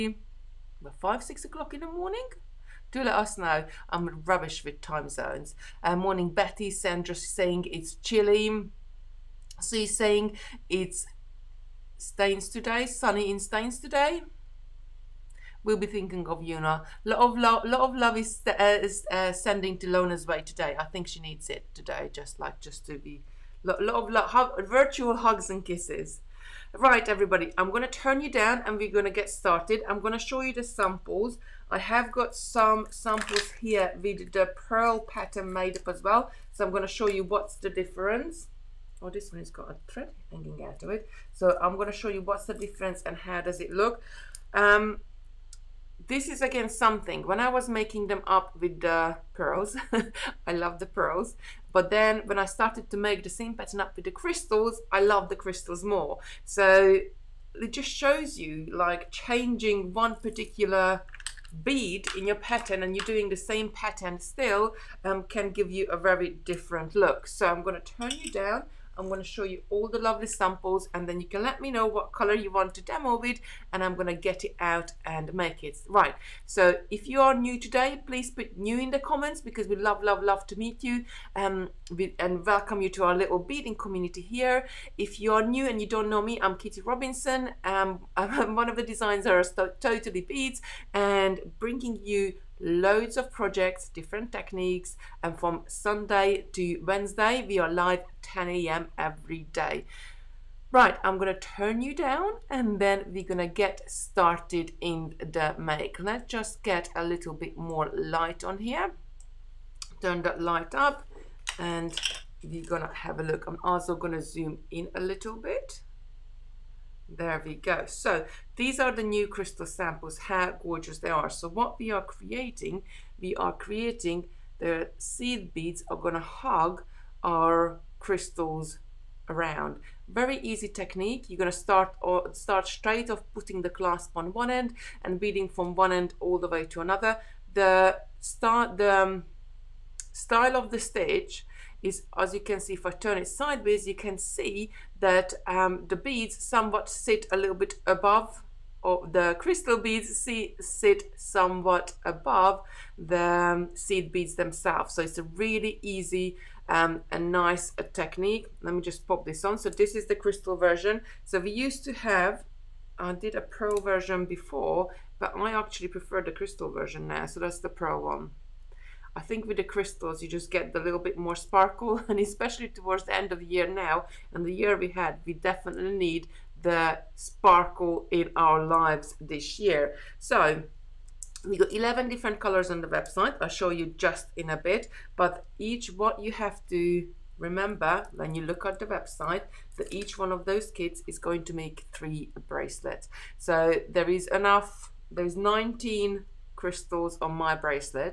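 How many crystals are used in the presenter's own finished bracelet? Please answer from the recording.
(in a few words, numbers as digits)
19.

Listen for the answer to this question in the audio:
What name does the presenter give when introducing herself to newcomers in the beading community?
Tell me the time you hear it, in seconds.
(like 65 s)
86 s.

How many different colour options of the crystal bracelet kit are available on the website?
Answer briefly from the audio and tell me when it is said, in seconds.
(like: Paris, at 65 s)
11, at 181 s.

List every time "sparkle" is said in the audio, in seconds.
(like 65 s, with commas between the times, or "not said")
171 s, 177 s.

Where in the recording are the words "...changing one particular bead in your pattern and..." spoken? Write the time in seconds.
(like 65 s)
59 s.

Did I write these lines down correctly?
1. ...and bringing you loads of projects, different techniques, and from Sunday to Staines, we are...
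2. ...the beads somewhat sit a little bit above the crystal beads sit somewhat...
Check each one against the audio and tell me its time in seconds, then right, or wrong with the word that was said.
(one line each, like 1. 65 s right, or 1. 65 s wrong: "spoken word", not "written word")
1. 90 s wrong: "Wednesday", not "Staines"
2. 145 s right.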